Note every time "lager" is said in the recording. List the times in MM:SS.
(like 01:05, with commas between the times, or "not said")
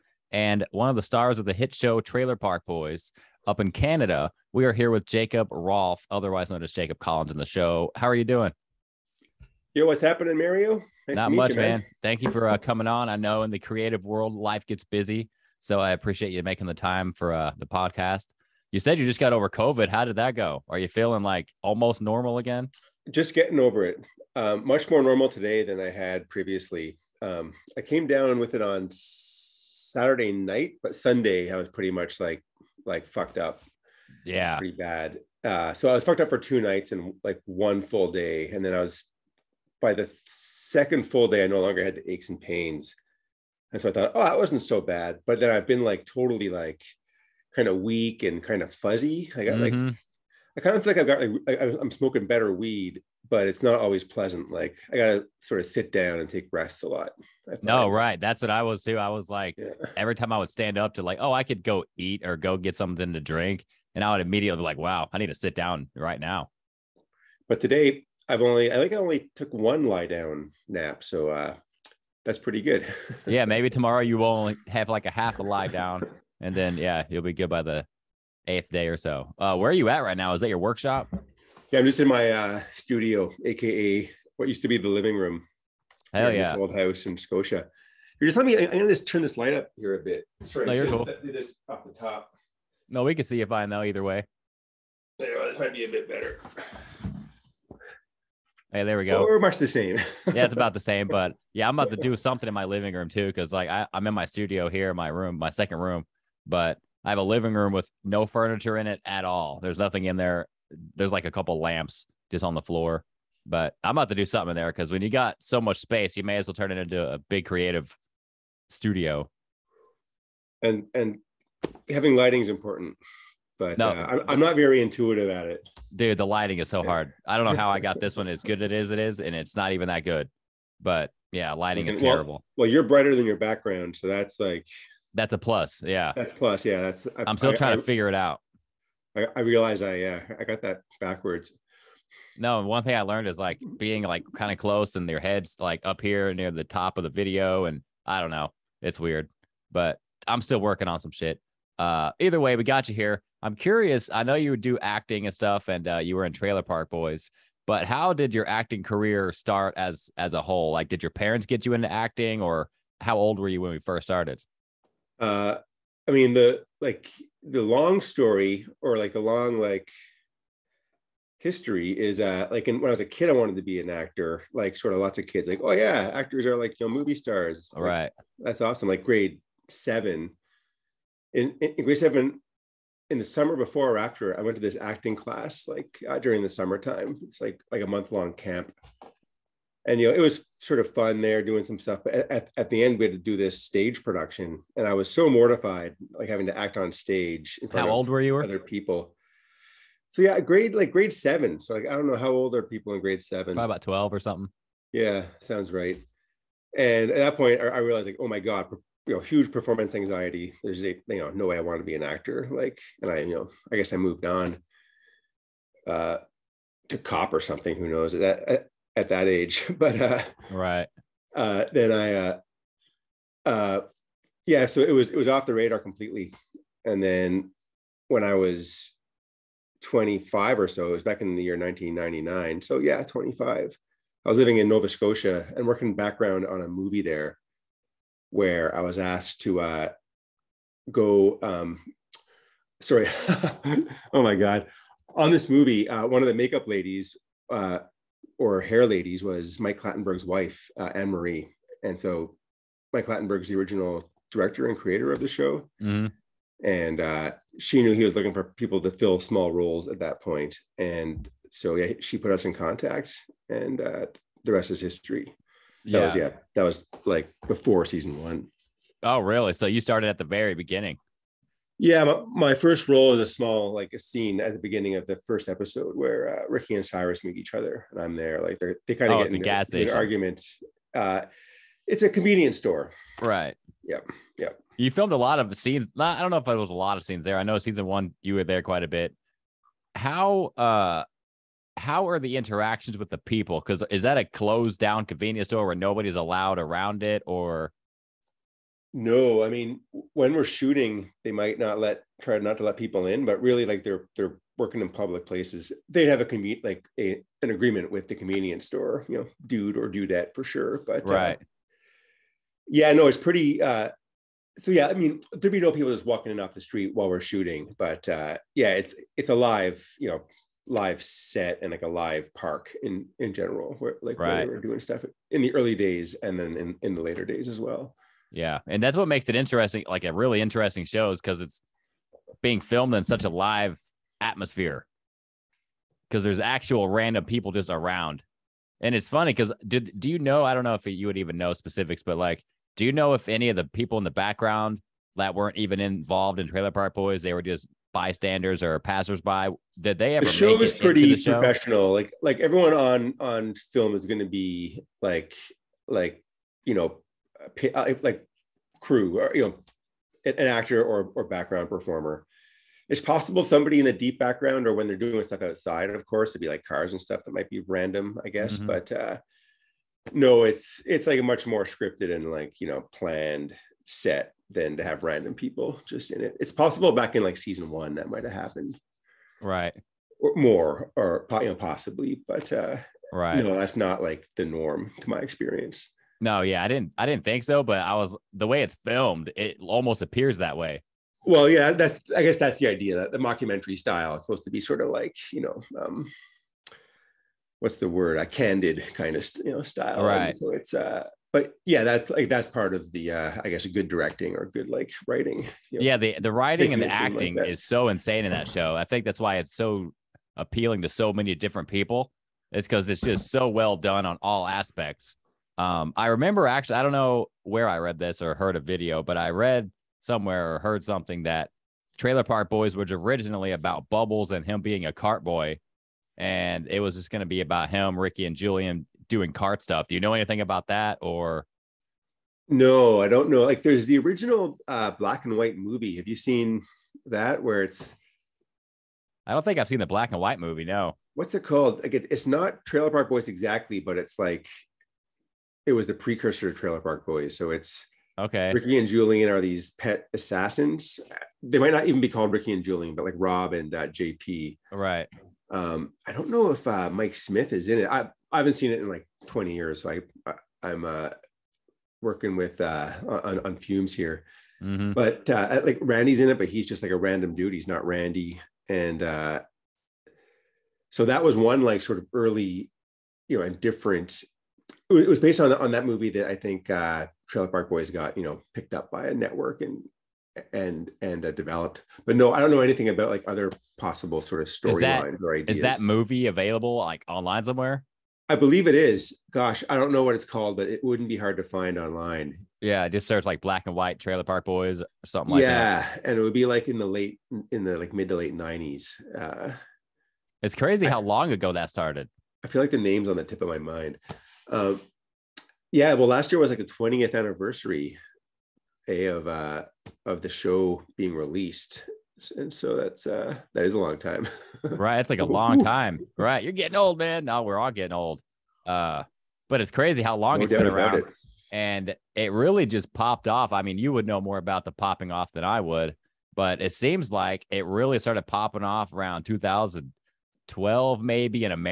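not said.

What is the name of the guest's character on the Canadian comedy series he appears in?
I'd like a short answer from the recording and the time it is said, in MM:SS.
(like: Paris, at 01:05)
Jacob Collins, at 00:06.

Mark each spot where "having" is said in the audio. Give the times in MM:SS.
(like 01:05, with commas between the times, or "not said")
02:01, 03:16.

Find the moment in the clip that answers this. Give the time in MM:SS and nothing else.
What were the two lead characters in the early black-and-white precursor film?
07:29.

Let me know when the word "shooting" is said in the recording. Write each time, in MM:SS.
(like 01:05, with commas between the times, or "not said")
05:00, 05:17.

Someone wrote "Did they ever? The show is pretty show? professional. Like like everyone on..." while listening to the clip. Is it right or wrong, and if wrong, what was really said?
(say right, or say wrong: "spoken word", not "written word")
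right.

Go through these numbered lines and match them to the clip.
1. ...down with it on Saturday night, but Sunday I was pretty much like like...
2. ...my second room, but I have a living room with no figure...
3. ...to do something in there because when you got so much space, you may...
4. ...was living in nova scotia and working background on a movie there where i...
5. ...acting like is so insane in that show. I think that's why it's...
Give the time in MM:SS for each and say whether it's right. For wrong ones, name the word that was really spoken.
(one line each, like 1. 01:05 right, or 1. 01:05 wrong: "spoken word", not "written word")
1. 00:28 right
2. 01:45 wrong: "furniture", not "figure"
3. 01:54 right
4. 03:54 right
5. 06:46 right.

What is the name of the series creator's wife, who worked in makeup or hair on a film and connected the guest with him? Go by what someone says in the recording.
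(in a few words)
Anne Marie.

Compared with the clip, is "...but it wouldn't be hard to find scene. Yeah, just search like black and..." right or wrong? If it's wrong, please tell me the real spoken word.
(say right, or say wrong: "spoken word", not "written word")
wrong: "online", not "scene".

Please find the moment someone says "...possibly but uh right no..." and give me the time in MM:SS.
06:21.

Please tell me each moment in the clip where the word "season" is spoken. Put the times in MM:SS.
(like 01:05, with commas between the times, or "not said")
04:27, 04:47, 06:17.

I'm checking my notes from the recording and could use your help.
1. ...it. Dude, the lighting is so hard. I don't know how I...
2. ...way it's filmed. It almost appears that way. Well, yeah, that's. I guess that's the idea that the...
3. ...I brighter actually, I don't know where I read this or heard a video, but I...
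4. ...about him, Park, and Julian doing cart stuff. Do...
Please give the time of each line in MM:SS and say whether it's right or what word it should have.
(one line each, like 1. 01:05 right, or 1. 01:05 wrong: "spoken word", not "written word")
1. 02:05 right
2. 06:28 right
3. 06:55 wrong: "remember", not "brighter"
4. 07:07 wrong: "Ricky", not "Park".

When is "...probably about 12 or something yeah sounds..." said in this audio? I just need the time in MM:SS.
03:23.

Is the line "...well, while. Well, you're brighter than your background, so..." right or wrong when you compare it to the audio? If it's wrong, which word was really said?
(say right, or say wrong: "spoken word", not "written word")
wrong: "terrible", not "while".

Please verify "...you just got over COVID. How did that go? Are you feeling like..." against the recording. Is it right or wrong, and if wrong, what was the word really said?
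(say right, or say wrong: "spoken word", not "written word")
right.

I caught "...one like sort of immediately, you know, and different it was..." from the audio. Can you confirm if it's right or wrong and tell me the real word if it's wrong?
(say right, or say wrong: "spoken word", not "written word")
wrong: "early", not "immediately".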